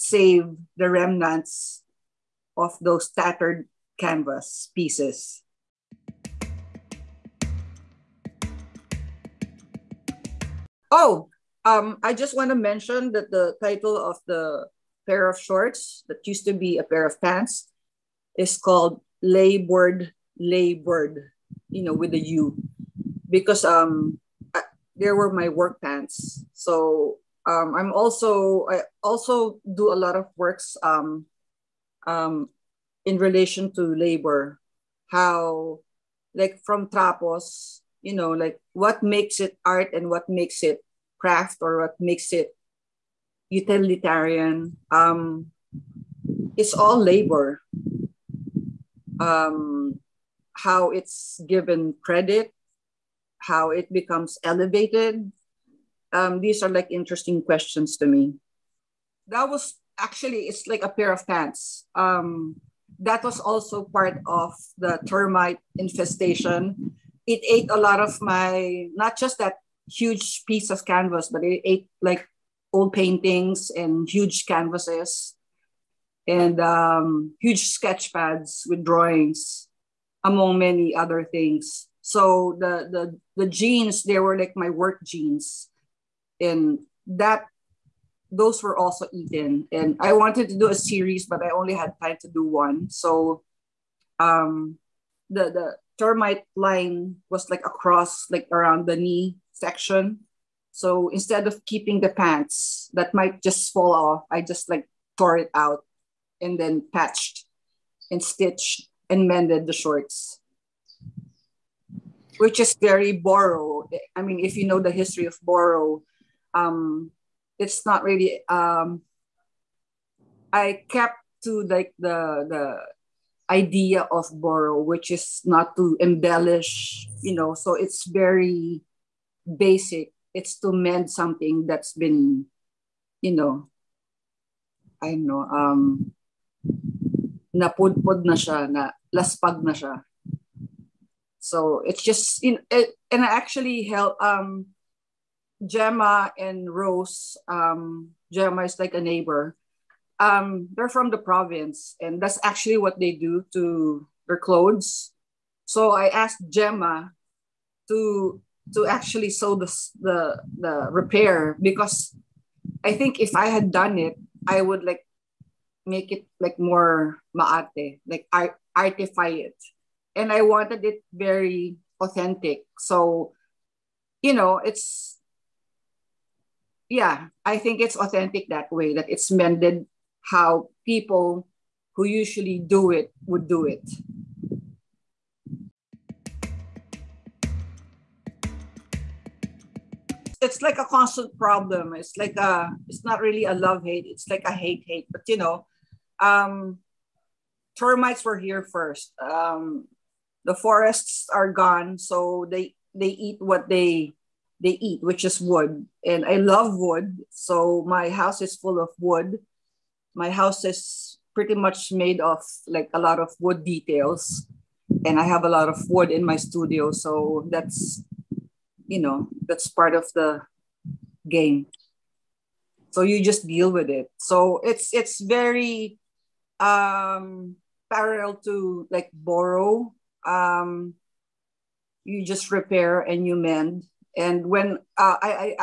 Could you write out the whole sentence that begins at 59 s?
That was actually, it's like a pair of pants.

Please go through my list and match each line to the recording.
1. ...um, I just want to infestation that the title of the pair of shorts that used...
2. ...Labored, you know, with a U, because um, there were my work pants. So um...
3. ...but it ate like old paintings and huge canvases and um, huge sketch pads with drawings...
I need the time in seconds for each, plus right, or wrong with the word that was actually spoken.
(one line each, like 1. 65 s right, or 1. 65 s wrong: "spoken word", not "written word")
1. 11 s wrong: "mention", not "infestation"
2. 20 s right
3. 71 s right.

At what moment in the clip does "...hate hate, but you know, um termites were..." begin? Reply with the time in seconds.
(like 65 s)
194 s.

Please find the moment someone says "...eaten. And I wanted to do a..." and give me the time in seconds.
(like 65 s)
89 s.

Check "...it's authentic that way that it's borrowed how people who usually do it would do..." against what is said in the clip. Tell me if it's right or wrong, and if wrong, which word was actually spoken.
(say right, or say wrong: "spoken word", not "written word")
wrong: "mended", not "borrowed".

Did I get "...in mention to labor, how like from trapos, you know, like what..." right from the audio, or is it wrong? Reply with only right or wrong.
wrong.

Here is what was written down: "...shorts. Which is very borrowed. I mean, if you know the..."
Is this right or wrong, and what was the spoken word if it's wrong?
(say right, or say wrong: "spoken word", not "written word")
right.